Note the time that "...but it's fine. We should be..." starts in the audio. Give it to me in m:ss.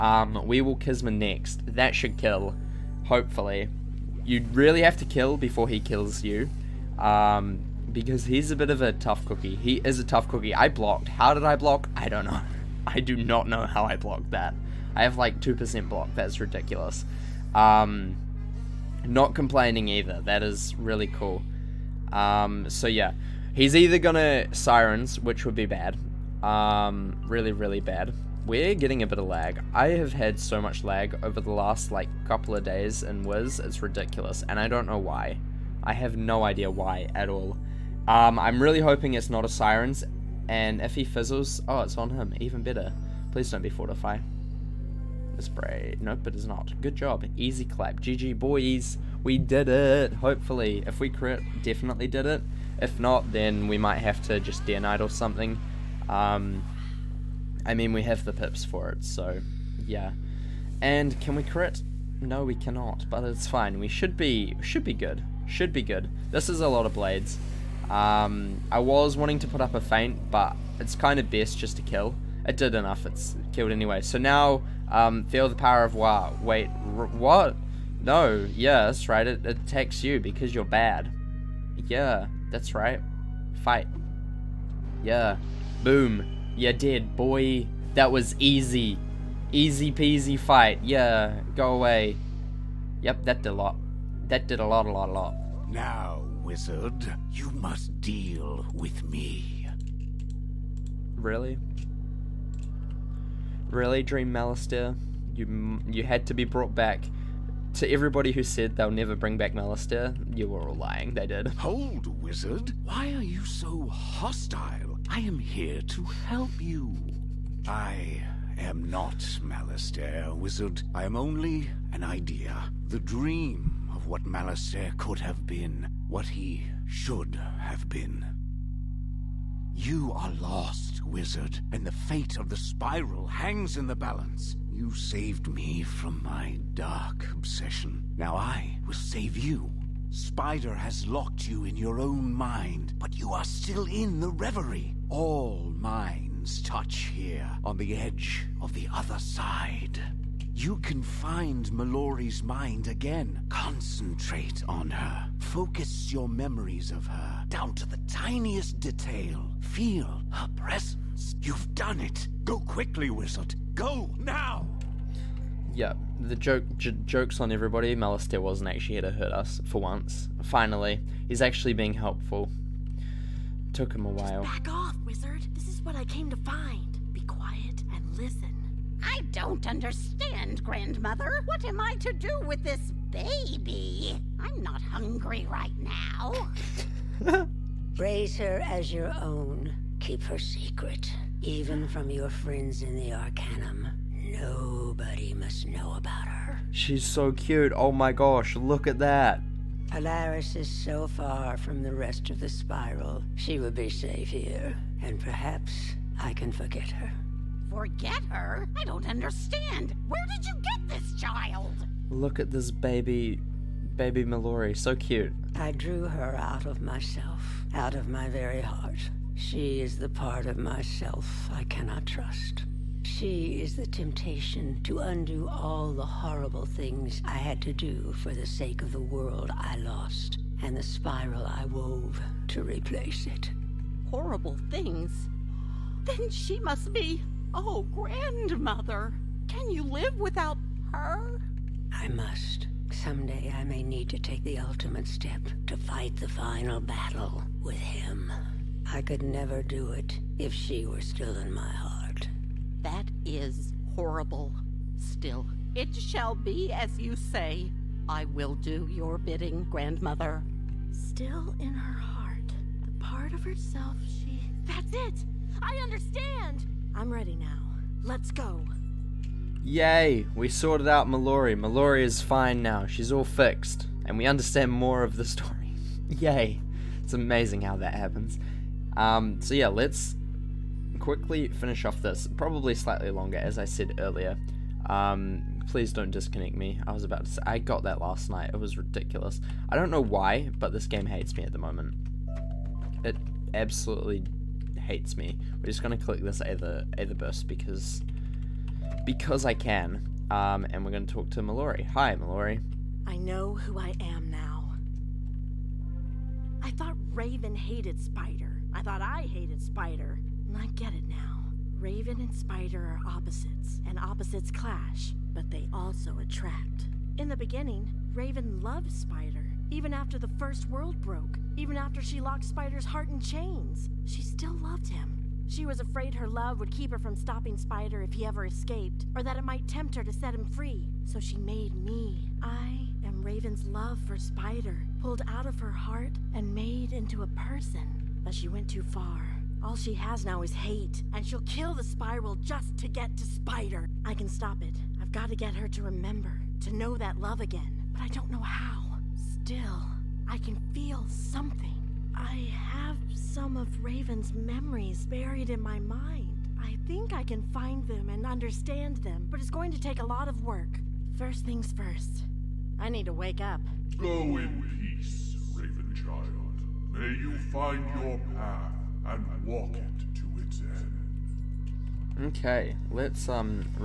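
1:03.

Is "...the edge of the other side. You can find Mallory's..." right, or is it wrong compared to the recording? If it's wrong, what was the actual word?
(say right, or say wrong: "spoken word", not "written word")
right.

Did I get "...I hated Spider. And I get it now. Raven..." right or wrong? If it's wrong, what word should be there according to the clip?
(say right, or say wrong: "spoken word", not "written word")
right.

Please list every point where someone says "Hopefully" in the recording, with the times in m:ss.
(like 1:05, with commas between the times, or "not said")
0:03, 0:50.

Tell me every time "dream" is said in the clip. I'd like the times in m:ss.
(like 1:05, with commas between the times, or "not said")
1:44, 2:02.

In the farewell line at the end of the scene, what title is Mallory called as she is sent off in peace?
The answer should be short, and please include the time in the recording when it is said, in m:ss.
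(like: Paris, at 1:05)
Raven Child, at 6:05.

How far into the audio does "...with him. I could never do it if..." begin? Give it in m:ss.
4:07.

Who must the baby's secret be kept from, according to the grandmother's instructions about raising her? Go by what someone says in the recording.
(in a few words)
Friends in the Arcanum.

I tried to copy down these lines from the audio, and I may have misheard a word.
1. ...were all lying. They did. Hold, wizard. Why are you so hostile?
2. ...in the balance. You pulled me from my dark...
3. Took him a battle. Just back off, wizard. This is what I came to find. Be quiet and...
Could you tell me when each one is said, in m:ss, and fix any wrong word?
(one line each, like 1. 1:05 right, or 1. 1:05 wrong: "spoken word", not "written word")
1. 1:50 right
2. 2:13 wrong: "saved", not "pulled"
3. 2:53 wrong: "while", not "battle".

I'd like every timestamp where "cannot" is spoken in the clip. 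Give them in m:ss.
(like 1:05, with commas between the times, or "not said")
1:02, 3:41.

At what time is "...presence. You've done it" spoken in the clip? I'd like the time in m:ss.
2:40.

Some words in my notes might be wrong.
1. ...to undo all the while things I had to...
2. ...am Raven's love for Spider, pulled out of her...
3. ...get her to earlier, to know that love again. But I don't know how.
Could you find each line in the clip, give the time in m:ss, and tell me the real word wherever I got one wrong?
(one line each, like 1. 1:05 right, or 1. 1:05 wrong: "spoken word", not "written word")
1. 3:44 wrong: "horrible", not "while"
2. 5:33 right
3. 5:45 wrong: "remember", not "earlier".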